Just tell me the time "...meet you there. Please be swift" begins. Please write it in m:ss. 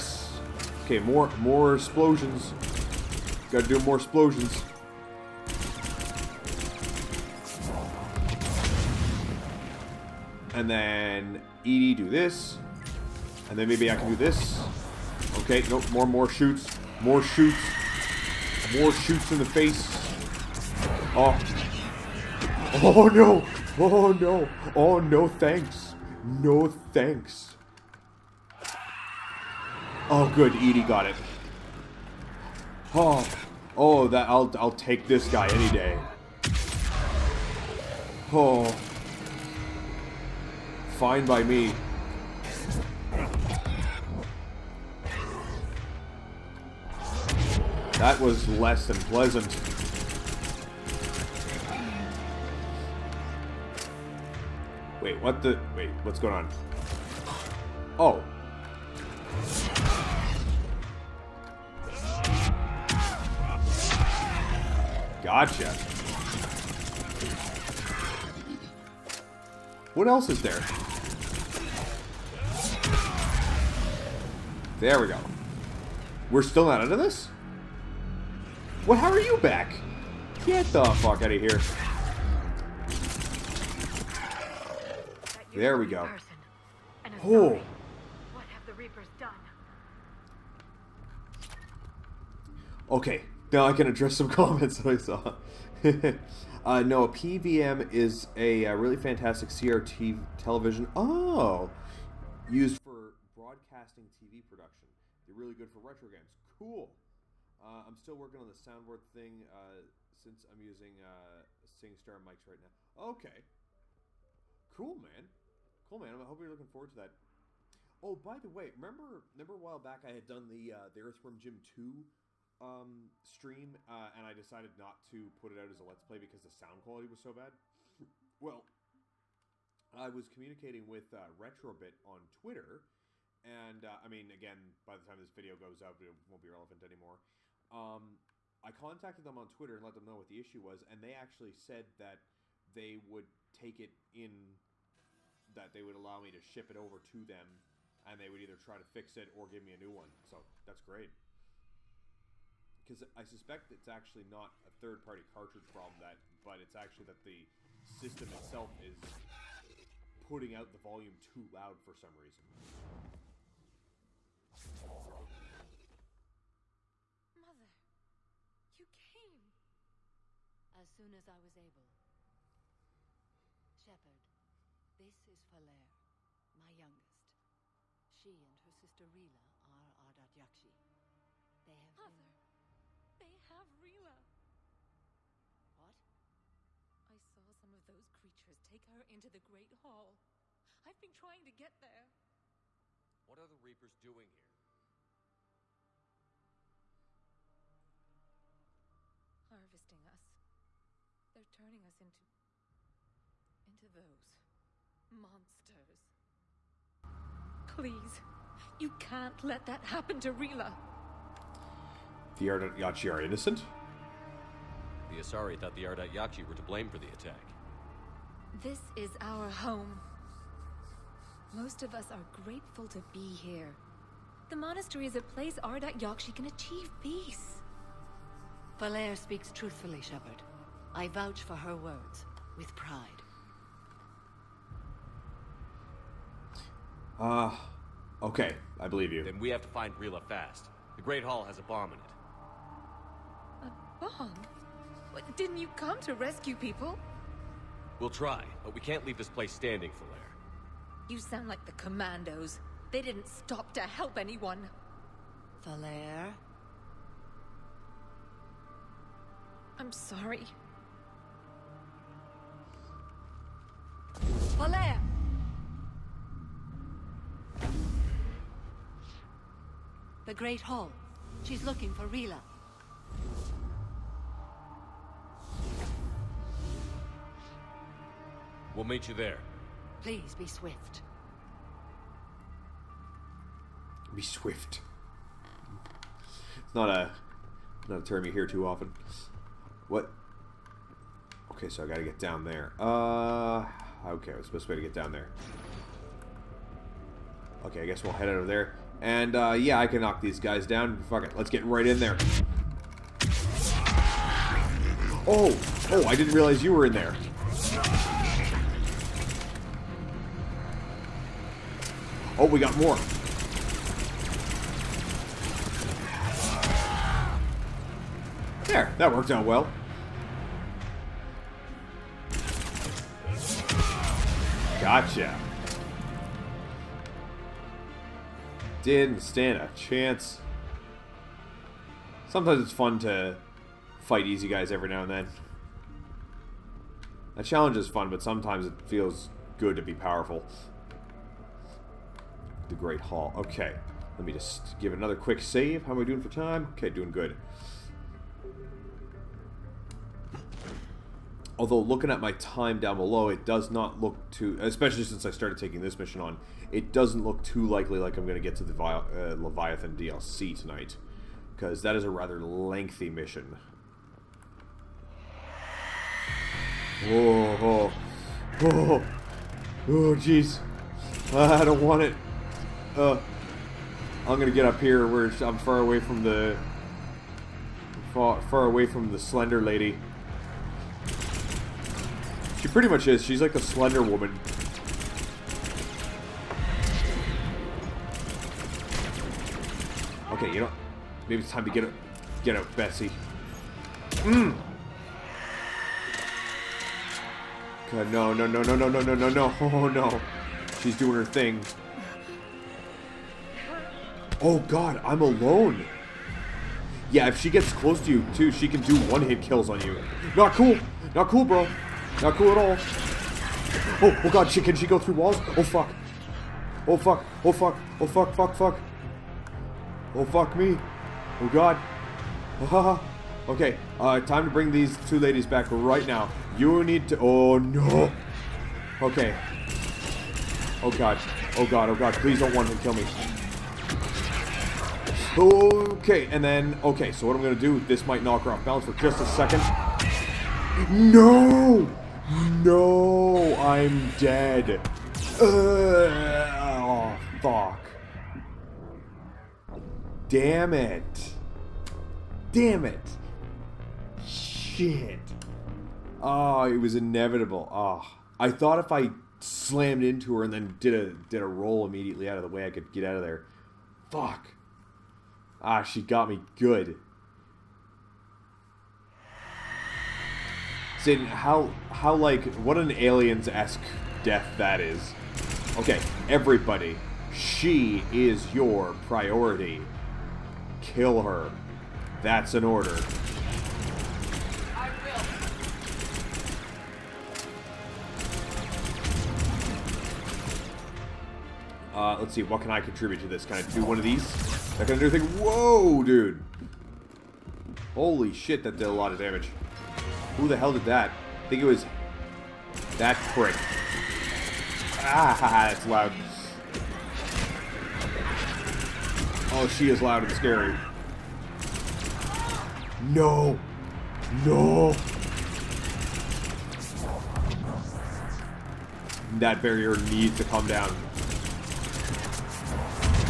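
4:38.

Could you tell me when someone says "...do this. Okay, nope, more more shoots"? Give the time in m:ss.
0:14.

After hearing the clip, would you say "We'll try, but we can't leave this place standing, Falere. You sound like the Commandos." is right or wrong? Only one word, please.
right.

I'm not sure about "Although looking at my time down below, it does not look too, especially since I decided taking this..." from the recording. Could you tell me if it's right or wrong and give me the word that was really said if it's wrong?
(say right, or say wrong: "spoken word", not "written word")
wrong: "started", not "decided".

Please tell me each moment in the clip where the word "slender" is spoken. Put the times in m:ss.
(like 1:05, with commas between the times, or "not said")
6:19, 6:23.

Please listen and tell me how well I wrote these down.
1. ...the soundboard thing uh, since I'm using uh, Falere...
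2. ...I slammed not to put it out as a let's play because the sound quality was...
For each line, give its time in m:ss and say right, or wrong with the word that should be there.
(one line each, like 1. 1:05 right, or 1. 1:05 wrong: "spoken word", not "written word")
1. 1:48 wrong: "SingStar", not "Falere"
2. 2:04 wrong: "decided", not "slammed".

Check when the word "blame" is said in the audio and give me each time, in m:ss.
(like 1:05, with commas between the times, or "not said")
3:36.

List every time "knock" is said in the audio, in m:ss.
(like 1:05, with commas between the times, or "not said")
5:00, 7:18.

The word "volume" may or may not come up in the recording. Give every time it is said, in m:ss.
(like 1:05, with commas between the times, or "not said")
2:40.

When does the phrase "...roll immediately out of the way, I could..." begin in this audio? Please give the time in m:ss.
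7:41.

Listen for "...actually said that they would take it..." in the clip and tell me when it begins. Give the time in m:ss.
2:21.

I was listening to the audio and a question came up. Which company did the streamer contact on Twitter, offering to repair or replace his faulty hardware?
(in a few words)
Retrobit.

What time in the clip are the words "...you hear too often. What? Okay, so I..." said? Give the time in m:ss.
4:48.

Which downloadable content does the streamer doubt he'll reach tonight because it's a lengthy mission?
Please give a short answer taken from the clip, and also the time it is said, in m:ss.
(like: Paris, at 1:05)
Leviathan, at 5:59.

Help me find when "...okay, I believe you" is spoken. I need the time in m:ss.
3:58.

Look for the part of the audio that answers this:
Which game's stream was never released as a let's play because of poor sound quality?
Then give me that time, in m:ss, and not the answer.
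2:01.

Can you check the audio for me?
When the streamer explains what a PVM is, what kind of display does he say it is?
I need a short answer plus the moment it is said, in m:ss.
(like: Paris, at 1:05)
CRT television, at 1:39.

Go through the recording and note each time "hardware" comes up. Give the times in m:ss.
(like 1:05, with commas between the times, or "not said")
not said.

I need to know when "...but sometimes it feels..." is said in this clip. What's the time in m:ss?
5:38.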